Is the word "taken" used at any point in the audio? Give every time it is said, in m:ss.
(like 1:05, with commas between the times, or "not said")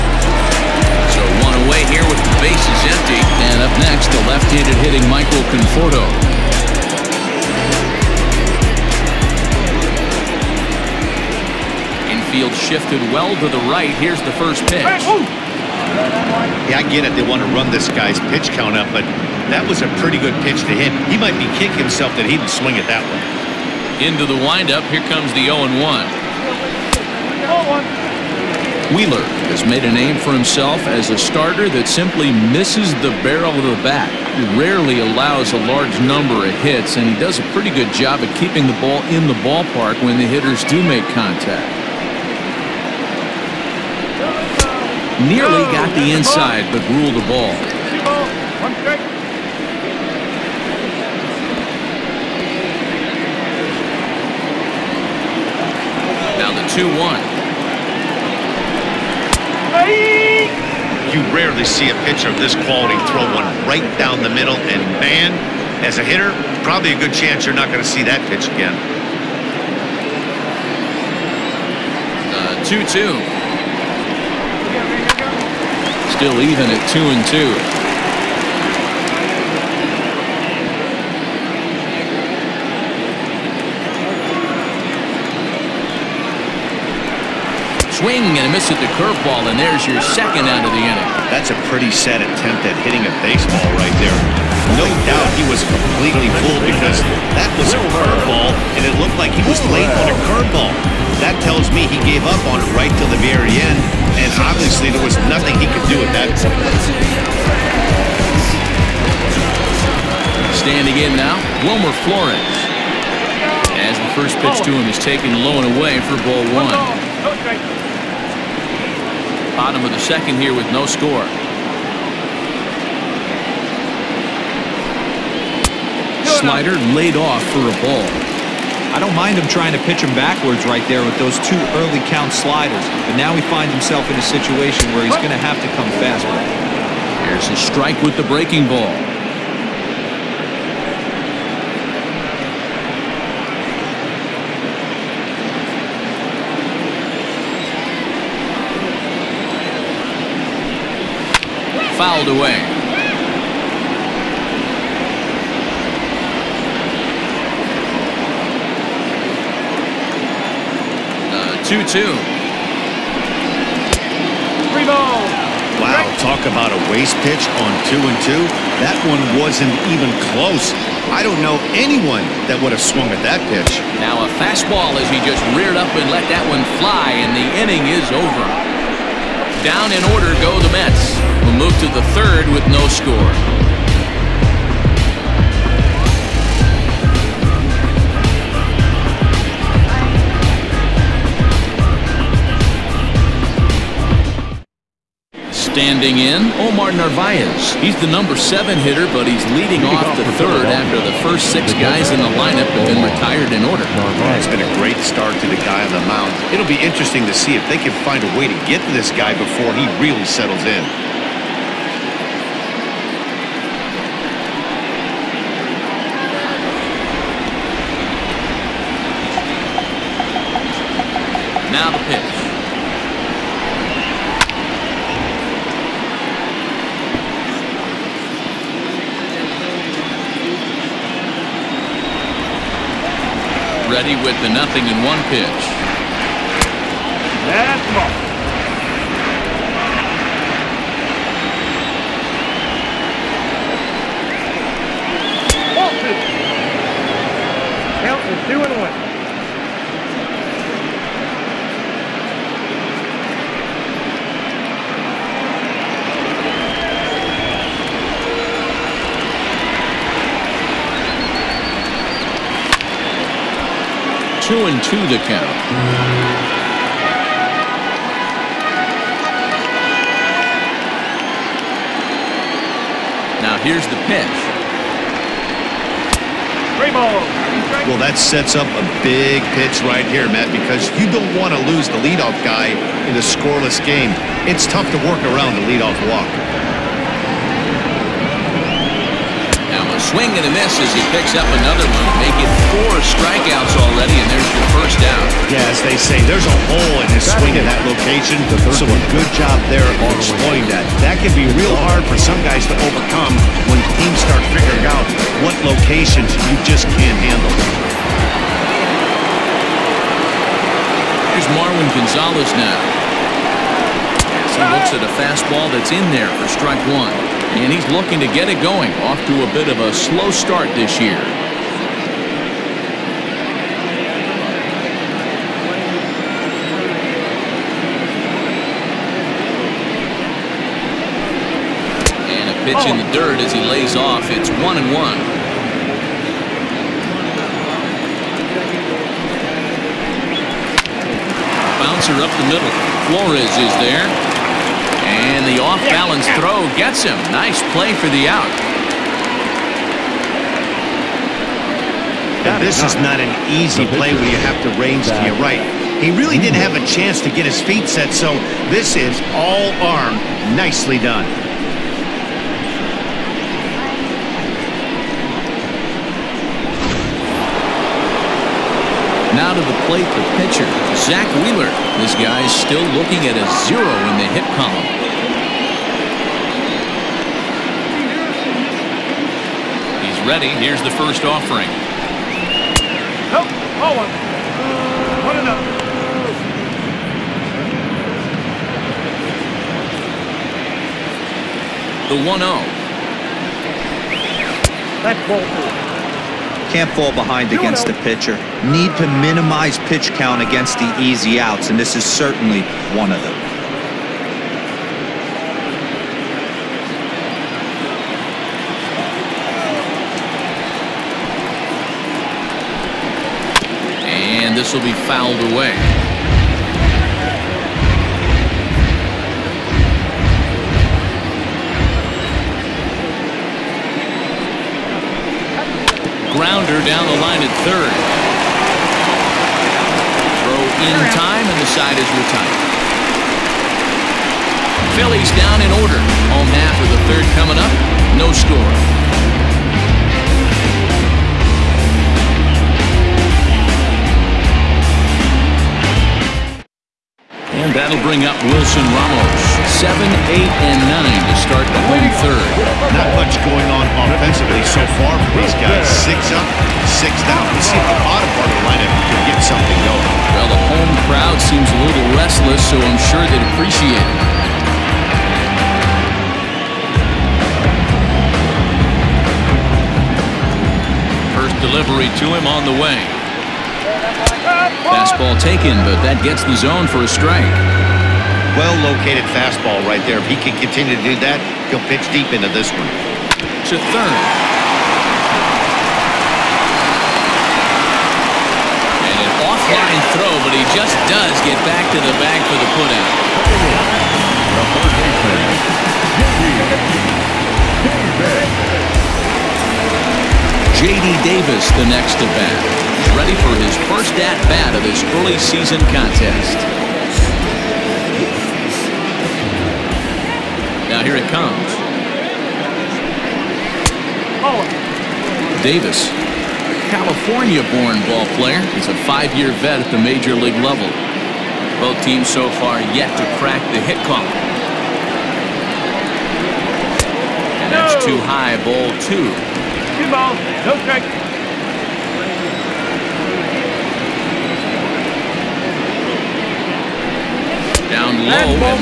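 1:54, 7:55.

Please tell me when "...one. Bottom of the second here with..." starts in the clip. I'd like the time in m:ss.
1:56.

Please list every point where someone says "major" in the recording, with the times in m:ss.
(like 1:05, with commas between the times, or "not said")
8:39.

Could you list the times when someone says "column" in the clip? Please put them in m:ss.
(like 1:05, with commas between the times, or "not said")
6:14, 8:44.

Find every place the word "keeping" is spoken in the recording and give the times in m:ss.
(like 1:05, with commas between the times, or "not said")
0:38.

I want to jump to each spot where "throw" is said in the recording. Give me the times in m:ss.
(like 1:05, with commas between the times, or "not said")
1:03, 5:46, 7:10, 8:10.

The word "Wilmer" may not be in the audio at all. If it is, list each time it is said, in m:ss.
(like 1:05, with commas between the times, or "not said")
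1:51.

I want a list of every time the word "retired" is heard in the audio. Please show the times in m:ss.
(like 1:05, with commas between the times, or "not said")
3:23, 7:12.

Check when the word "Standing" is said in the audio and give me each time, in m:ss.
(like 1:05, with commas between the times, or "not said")
1:50, 3:15.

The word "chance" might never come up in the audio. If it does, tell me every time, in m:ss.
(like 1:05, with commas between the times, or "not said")
1:07, 5:56.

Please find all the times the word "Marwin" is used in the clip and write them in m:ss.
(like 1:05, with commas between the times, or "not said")
5:11.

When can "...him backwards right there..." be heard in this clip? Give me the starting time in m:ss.
2:10.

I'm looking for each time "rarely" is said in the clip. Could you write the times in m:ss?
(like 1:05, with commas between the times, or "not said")
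0:34, 1:01.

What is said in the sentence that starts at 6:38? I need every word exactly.
Need to minimize pitch count against the easy outs, and this is certainly one of them.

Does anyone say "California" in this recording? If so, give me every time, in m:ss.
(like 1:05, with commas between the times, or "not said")
8:36.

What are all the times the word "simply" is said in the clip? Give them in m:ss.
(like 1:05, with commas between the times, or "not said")
0:31.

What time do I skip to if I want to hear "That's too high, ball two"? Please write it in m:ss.
8:47.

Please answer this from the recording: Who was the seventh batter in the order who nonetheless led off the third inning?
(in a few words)
Omar Narvaez.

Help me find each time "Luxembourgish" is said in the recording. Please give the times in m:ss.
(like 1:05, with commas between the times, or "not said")
not said.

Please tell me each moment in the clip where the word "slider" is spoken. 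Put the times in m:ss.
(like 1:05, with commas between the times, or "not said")
2:06, 2:12.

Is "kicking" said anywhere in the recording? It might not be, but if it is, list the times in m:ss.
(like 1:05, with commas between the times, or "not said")
0:21.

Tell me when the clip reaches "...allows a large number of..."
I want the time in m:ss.
0:34.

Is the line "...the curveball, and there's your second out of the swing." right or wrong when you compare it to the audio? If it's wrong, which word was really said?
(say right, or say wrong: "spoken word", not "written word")
wrong: "inning", not "swing".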